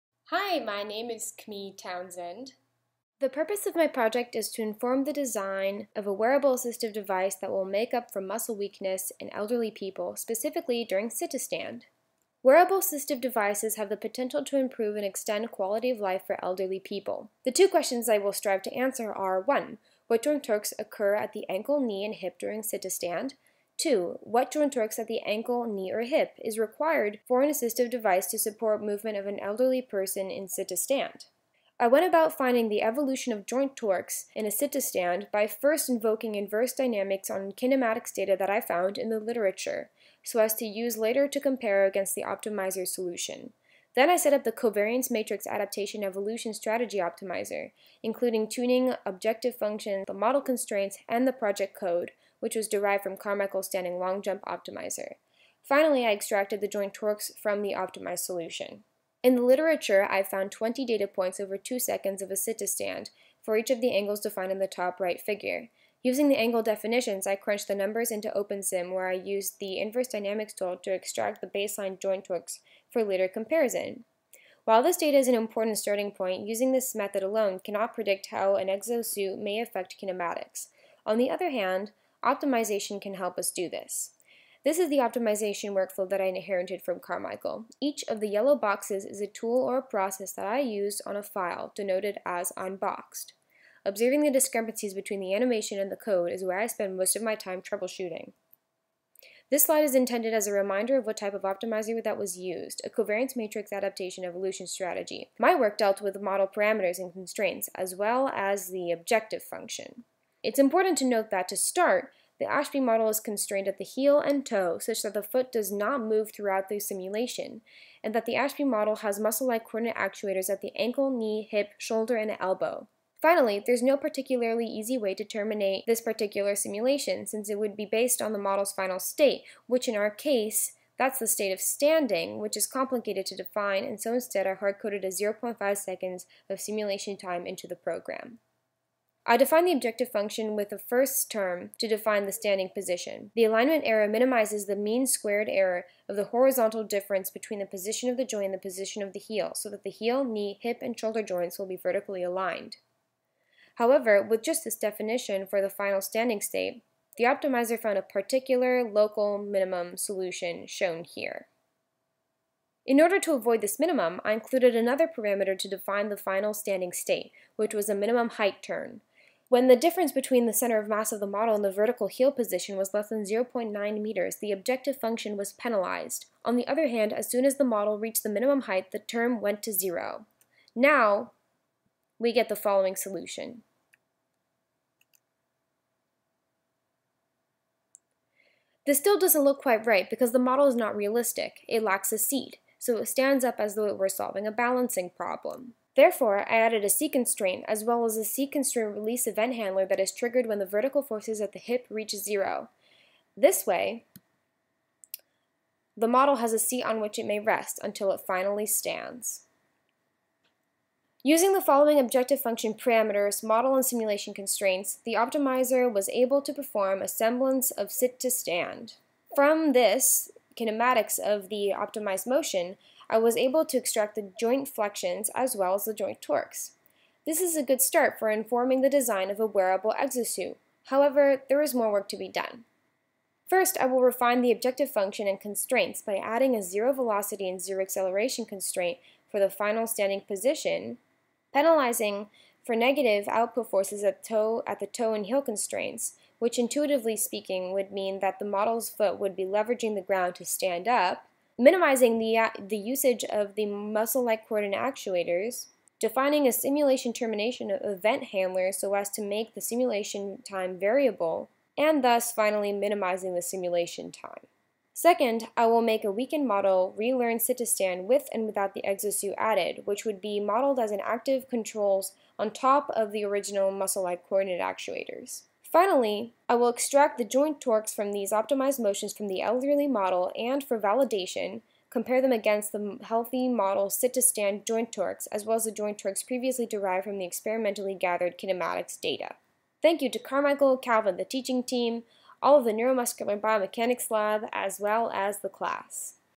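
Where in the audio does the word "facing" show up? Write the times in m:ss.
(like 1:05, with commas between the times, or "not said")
not said.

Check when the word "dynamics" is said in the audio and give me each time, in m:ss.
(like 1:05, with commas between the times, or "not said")
0:36, 1:10.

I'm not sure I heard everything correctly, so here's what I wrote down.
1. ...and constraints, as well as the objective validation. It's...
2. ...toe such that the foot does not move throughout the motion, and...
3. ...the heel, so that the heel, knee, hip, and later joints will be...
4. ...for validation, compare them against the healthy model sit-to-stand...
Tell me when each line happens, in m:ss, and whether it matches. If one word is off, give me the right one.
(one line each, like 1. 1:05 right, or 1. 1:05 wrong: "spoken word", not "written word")
1. 1:46 wrong: "function", not "validation"
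2. 1:54 wrong: "simulation", not "motion"
3. 2:29 wrong: "shoulder", not "later"
4. 4:40 right.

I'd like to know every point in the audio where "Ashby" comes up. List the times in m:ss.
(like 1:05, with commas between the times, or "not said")
1:52, 1:58.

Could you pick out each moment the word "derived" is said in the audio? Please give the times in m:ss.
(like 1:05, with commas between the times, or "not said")
0:52, 4:46.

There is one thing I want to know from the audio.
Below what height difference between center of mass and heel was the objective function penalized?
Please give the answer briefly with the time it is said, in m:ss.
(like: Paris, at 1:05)
0.9 meters, at 2:53.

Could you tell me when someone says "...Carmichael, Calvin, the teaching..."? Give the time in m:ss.
4:50.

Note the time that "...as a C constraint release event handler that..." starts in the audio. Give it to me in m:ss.
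3:18.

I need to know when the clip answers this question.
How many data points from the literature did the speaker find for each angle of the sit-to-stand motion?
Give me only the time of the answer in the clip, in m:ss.
1:00.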